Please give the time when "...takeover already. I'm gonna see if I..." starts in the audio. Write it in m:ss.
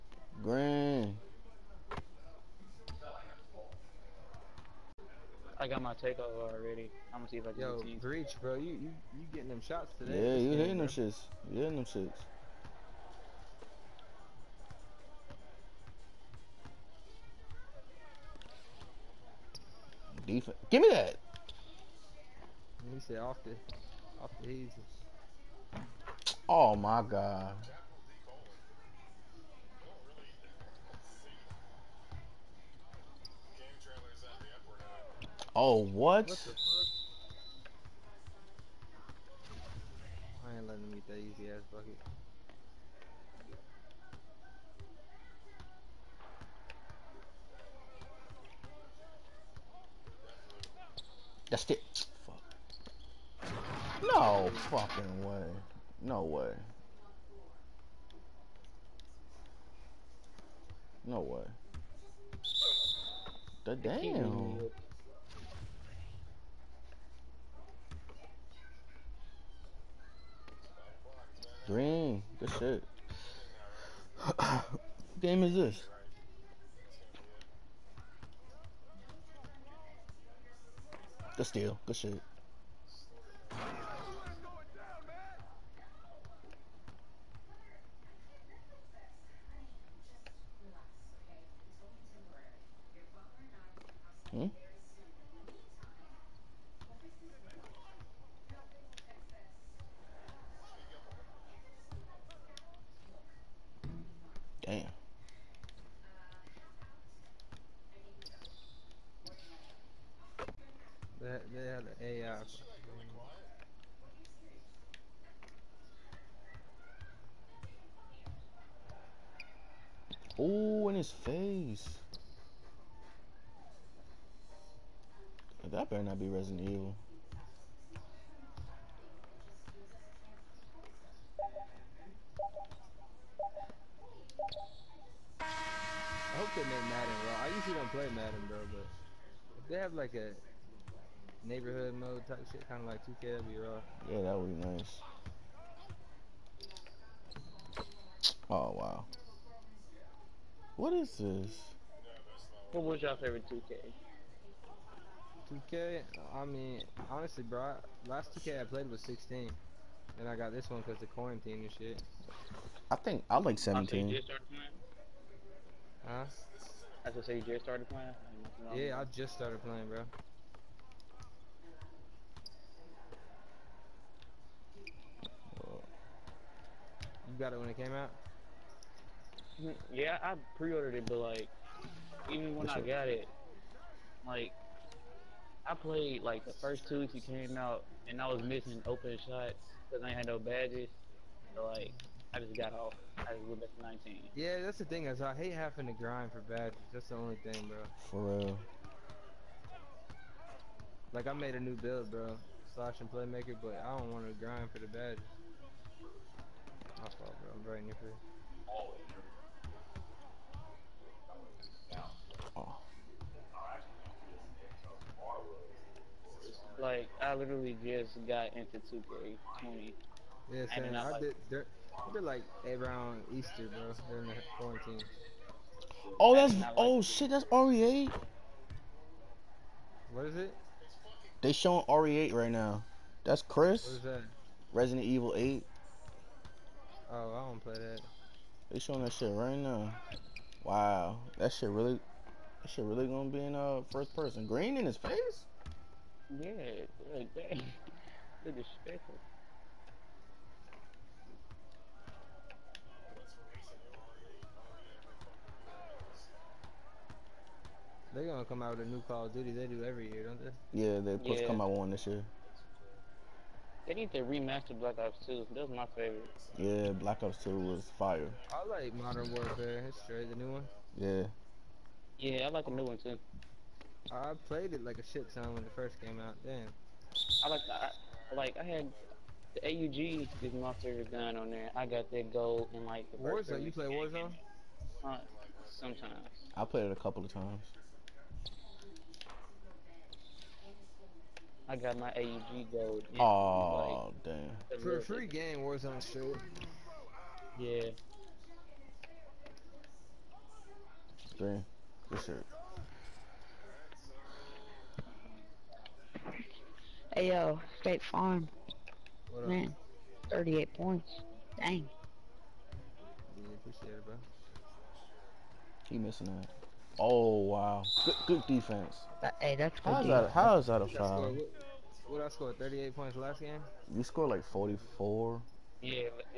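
0:05.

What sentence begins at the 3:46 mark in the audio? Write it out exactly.
Oh, that's oh like shit, that's RE8.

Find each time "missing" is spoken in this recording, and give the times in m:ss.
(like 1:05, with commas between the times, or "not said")
3:08, 5:15.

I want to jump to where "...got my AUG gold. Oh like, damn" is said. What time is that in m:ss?
4:51.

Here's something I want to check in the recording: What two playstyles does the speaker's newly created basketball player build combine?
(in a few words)
Slash and playmaker.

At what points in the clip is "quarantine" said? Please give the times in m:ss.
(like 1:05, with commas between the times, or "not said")
2:41, 3:44.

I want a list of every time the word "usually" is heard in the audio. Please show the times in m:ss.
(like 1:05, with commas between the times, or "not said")
2:17.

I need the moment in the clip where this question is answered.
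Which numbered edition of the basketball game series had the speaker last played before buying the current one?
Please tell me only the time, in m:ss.
2:39.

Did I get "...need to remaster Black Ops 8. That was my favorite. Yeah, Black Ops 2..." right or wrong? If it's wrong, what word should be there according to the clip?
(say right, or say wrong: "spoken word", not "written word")
wrong: "2", not "8".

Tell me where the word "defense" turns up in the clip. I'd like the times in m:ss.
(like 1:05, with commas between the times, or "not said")
0:20, 5:18.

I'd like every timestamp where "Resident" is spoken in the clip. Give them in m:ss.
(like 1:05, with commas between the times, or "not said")
2:06, 3:54.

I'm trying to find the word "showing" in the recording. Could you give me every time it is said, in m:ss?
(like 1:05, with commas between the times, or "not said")
3:51, 3:58.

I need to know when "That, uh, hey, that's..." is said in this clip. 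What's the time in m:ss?
5:19.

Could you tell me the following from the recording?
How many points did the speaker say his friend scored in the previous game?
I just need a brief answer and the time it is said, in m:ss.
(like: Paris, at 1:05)
44, at 5:24.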